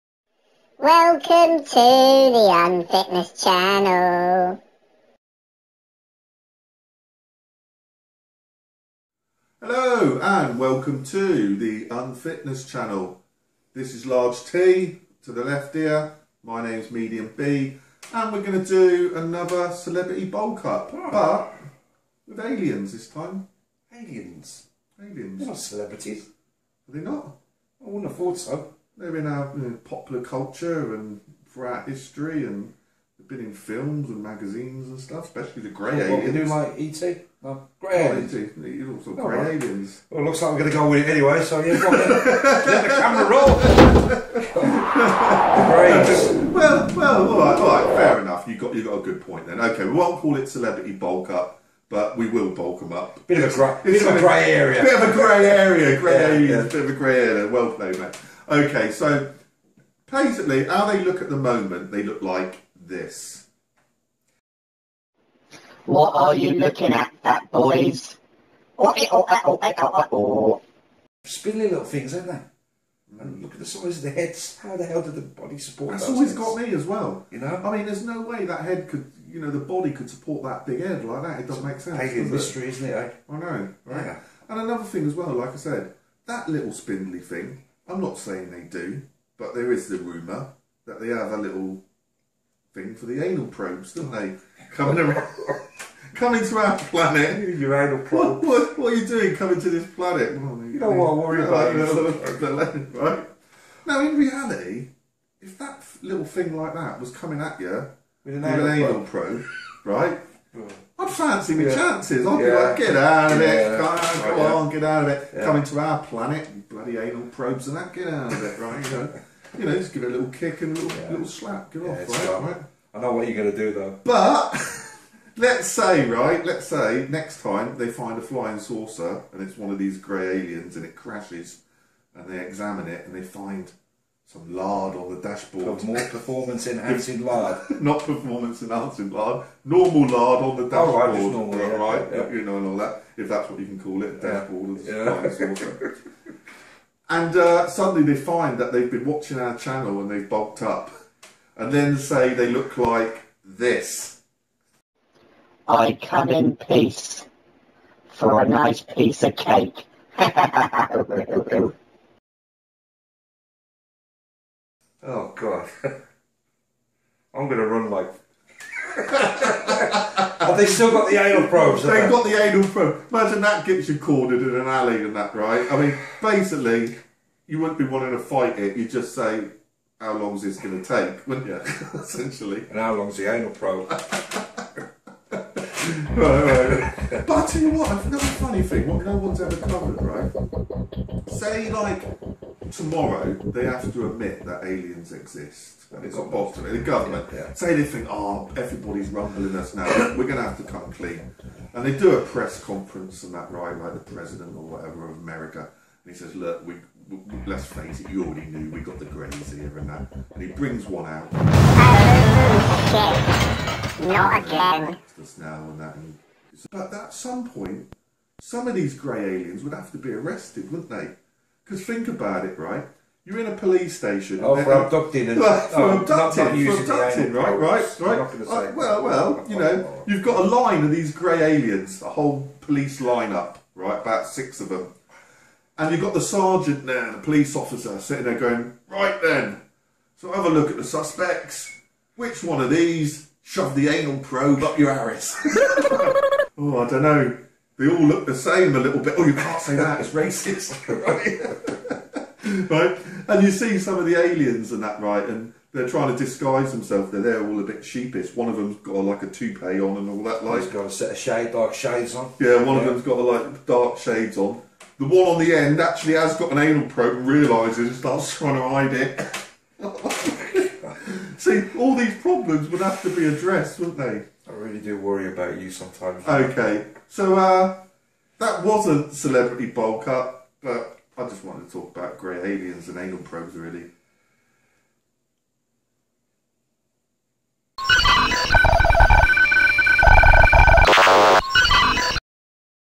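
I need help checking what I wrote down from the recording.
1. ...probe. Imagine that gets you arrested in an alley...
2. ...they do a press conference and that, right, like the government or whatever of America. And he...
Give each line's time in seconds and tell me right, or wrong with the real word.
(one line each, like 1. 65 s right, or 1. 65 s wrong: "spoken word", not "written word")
1. 172 s wrong: "cornered", not "arrested"
2. 201 s wrong: "president", not "government".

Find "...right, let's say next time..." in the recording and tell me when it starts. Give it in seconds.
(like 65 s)
126 s.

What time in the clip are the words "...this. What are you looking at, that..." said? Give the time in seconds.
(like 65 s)
62 s.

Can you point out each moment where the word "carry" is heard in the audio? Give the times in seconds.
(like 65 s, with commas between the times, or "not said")
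not said.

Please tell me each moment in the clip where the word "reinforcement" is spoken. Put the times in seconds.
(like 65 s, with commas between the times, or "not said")
not said.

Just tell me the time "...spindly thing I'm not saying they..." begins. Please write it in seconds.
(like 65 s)
86 s.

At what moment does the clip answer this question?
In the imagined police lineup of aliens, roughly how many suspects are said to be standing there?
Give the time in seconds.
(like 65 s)
234 s.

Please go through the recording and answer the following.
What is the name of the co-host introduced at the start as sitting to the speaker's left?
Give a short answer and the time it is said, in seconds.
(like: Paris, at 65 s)
Large T, at 14 s.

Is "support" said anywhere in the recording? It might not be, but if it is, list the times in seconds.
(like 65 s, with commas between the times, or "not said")
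75 s, 80 s.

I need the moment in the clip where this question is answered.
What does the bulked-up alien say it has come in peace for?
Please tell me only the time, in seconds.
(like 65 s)
158 s.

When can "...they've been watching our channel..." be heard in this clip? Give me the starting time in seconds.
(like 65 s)
148 s.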